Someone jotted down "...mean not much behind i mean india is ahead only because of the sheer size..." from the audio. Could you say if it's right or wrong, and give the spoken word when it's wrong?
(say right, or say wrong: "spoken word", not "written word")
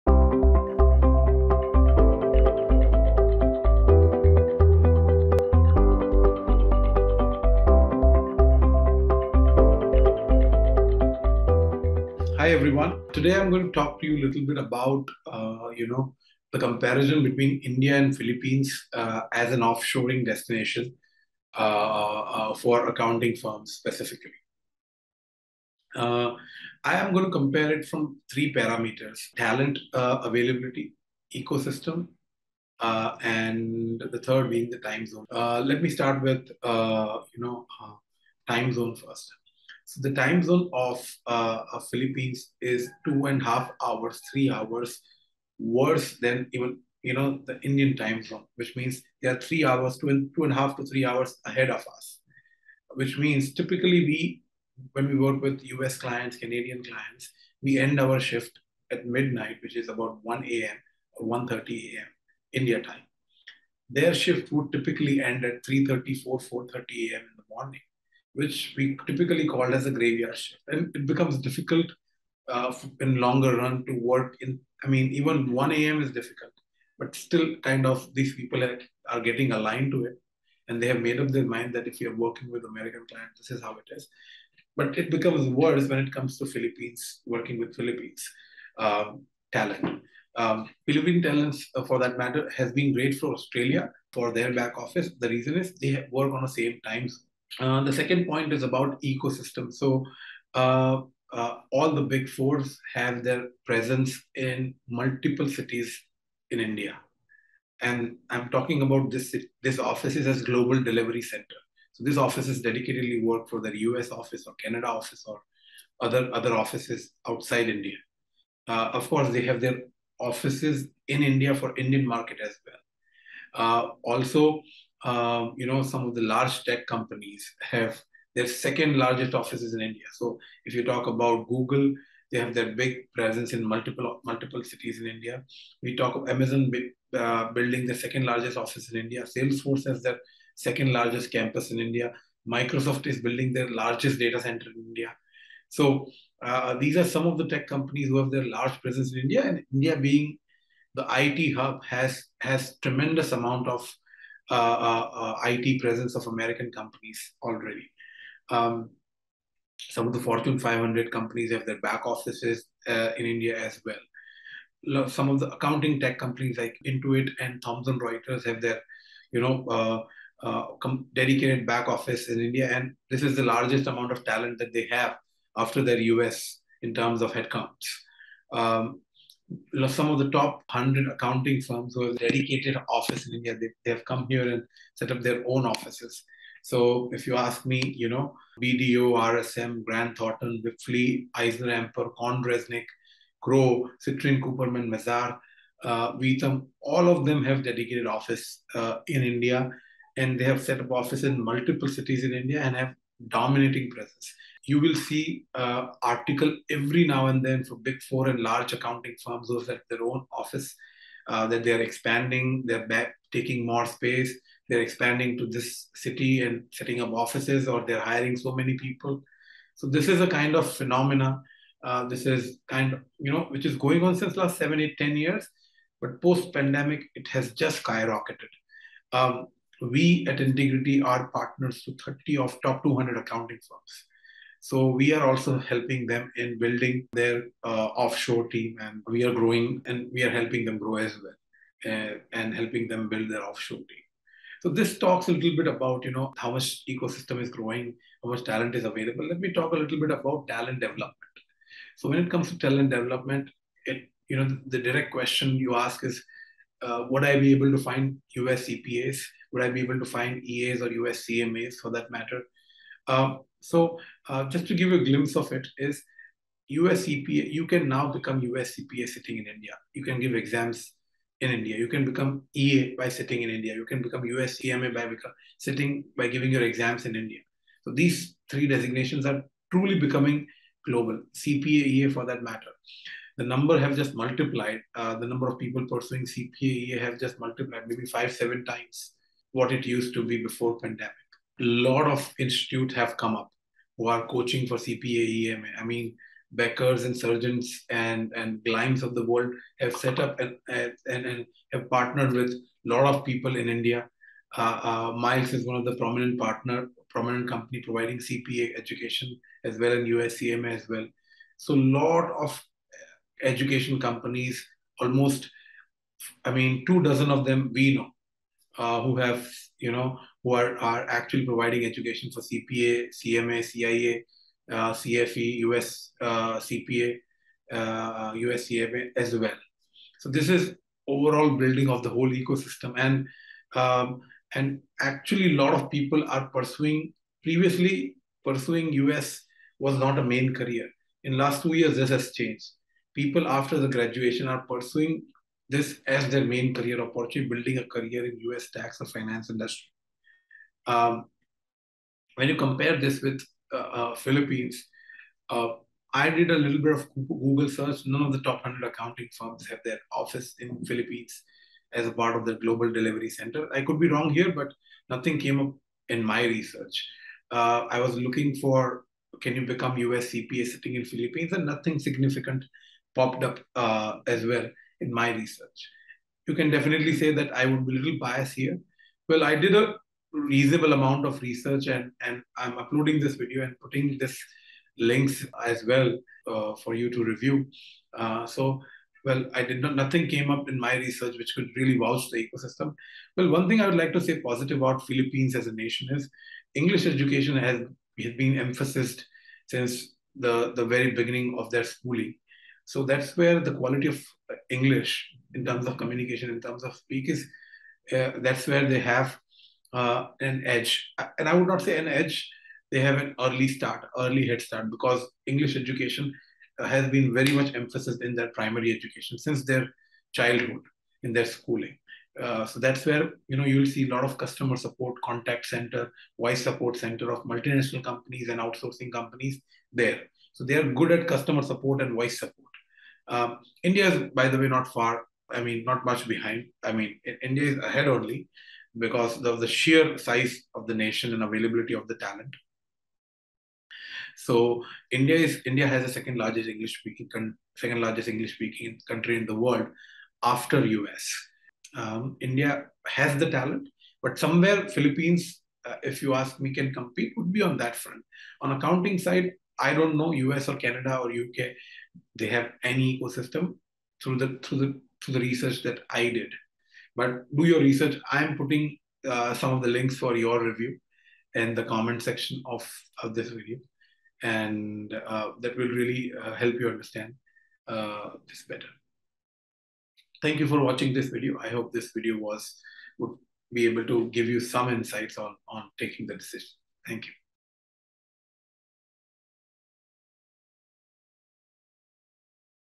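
right.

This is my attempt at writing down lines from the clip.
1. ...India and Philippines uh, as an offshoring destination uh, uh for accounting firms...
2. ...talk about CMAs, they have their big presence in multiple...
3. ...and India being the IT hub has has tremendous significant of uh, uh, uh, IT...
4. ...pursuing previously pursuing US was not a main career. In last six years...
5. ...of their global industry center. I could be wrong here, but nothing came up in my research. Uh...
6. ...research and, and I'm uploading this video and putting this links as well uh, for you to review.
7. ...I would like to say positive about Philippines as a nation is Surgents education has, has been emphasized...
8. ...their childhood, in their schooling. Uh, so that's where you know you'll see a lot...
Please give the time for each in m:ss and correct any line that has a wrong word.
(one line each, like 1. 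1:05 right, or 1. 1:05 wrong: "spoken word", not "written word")
1. 0:17 right
2. 2:10 wrong: "Google", not "CMAs"
3. 2:29 wrong: "amount", not "significant"
4. 5:36 wrong: "two", not "six"
5. 6:02 wrong: "delivery", not "industry"
6. 6:21 right
7. 6:33 wrong: "English", not "Surgents"
8. 6:59 right.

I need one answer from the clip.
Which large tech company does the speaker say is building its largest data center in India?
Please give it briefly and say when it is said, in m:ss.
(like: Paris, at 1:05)
Microsoft, at 2:22.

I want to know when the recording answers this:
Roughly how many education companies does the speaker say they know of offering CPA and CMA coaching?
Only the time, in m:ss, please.
5:16.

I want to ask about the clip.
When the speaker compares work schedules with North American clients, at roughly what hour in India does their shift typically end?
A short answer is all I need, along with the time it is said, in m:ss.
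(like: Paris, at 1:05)
1 a.m., at 1:00.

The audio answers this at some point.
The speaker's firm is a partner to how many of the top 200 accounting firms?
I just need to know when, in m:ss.
3:52.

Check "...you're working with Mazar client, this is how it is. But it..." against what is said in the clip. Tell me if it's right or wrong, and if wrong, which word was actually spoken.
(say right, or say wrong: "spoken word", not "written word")
wrong: "American", not "Mazar".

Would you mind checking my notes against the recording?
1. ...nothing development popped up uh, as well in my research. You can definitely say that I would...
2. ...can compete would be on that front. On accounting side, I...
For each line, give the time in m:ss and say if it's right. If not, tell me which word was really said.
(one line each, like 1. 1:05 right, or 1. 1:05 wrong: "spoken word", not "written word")
1. 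6:11 wrong: "significant", not "development"
2. 7:36 right.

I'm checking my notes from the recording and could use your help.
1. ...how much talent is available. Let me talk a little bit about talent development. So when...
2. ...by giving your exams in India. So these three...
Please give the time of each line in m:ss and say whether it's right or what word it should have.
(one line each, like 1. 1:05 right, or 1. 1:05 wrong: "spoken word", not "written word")
1. 4:08 right
2. 4:36 right.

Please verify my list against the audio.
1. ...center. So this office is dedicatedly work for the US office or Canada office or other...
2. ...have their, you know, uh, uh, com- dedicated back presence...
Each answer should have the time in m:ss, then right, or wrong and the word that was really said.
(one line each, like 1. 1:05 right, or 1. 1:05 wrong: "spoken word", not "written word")
1. 1:51 right
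2. 2:48 wrong: "office", not "presence".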